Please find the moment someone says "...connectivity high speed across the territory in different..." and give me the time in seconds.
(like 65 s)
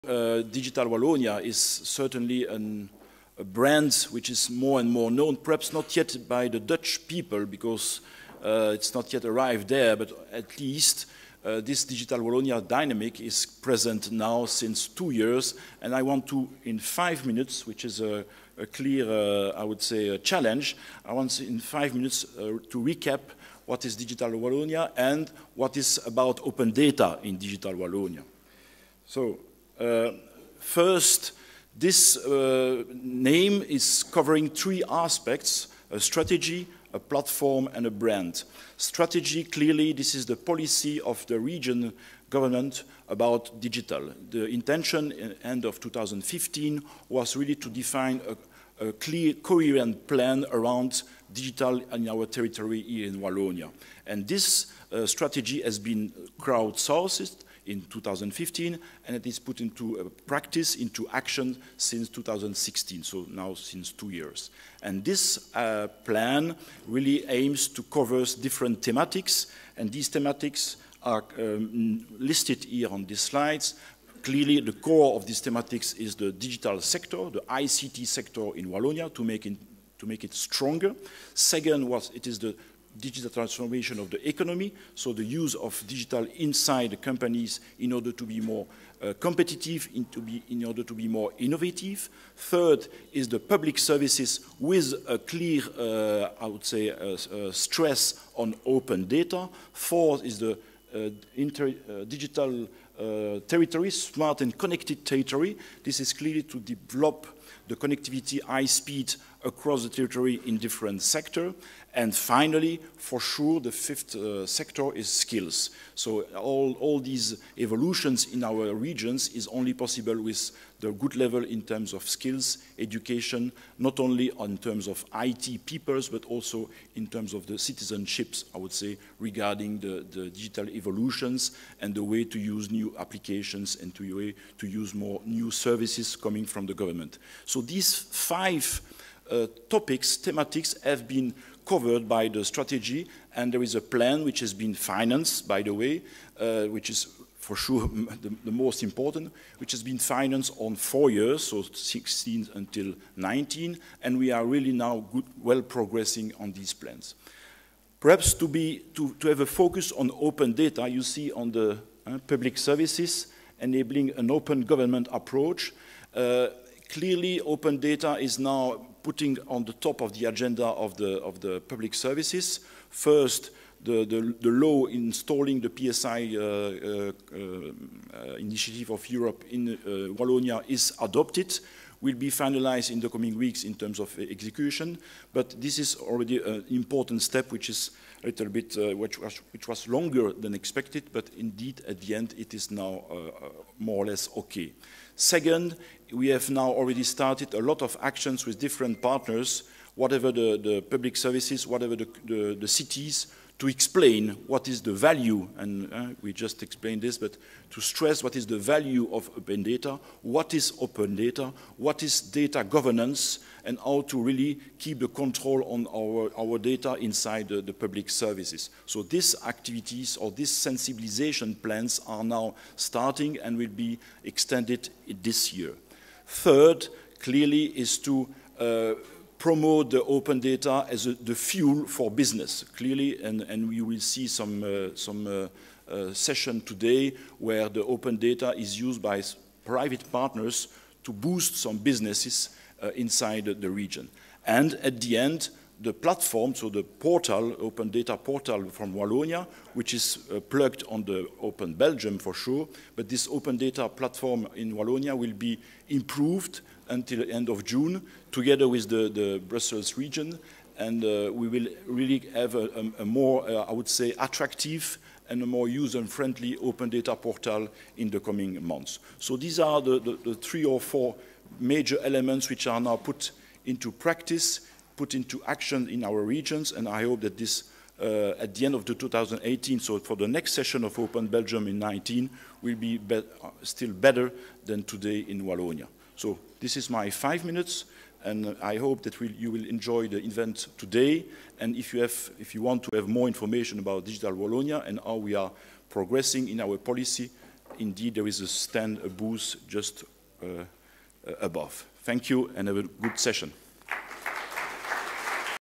107 s.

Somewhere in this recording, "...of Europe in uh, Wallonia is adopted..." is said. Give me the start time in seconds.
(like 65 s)
178 s.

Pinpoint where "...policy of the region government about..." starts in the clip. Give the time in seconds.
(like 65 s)
40 s.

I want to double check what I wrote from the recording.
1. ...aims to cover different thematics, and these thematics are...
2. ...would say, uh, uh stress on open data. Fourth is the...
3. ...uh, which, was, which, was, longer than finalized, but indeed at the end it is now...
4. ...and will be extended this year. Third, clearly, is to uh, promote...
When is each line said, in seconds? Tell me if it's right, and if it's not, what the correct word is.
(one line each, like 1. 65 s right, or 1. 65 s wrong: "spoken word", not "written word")
1. 67 s right
2. 96 s right
3. 188 s wrong: "expected", not "finalized"
4. 223 s right.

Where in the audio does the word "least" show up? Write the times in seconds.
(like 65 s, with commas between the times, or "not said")
10 s.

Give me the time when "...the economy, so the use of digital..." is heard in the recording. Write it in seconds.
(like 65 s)
84 s.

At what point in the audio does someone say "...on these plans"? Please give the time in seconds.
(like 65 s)
156 s.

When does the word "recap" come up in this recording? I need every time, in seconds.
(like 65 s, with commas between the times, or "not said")
22 s.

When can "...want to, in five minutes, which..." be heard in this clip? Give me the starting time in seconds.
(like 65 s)
16 s.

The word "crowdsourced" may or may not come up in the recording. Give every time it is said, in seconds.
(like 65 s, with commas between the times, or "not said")
56 s.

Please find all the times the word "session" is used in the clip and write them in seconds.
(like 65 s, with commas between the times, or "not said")
236 s, 280 s, 303 s.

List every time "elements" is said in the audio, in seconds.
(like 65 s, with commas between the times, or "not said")
272 s.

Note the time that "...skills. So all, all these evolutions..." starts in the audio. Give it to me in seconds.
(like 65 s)
115 s.